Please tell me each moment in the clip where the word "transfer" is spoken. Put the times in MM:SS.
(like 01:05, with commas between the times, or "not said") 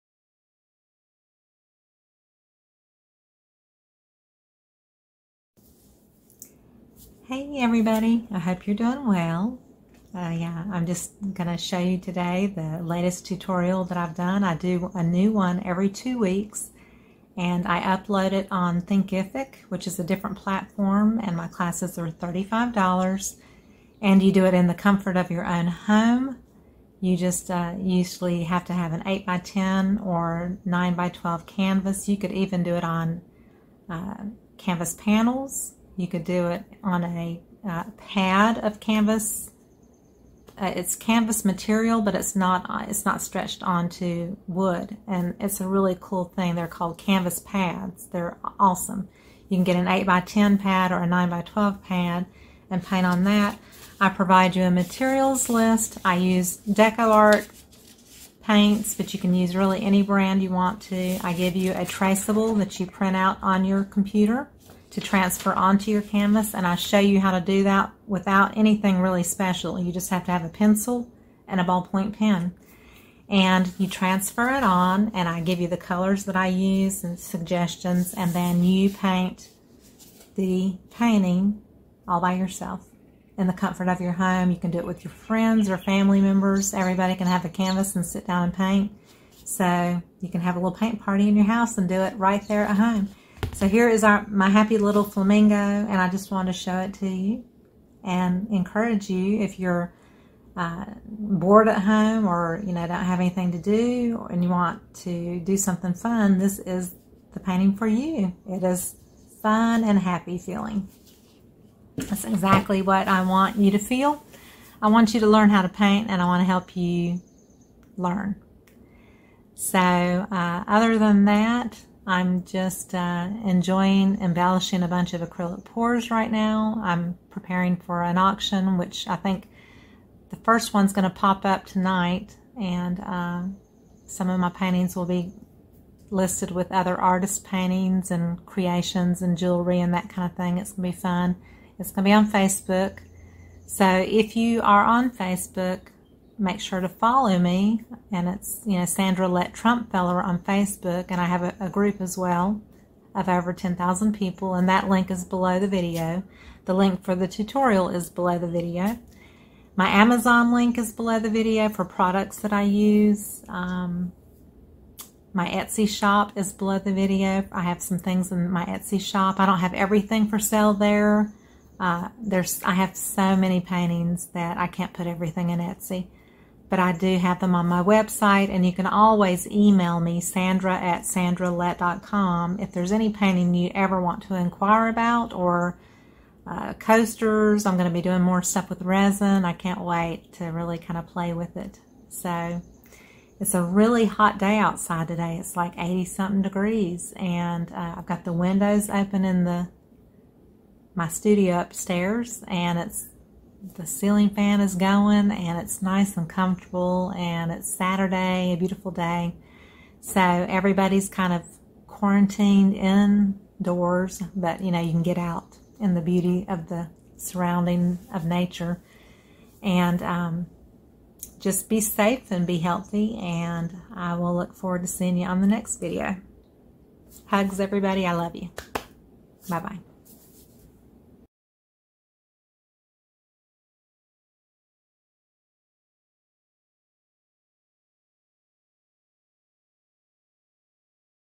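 01:05, 01:13.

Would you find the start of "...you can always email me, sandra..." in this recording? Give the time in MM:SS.
02:58.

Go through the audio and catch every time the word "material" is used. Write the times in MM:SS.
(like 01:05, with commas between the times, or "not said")
00:41, 00:54.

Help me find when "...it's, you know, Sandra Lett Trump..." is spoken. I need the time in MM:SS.
02:28.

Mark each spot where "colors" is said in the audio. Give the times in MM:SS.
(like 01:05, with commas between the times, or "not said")
01:15.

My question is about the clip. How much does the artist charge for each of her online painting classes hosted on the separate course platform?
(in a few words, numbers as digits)
$35.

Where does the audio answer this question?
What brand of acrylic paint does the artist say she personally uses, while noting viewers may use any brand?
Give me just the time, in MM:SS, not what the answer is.
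00:56.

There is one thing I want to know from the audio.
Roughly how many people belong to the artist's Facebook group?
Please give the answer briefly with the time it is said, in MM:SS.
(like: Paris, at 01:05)
Over 10,000, at 02:33.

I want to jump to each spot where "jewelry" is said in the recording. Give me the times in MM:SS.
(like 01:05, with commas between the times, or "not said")
02:19.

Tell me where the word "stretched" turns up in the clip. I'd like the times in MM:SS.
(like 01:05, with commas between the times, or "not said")
00:43.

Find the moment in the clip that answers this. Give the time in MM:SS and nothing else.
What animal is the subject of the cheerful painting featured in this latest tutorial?
01:35.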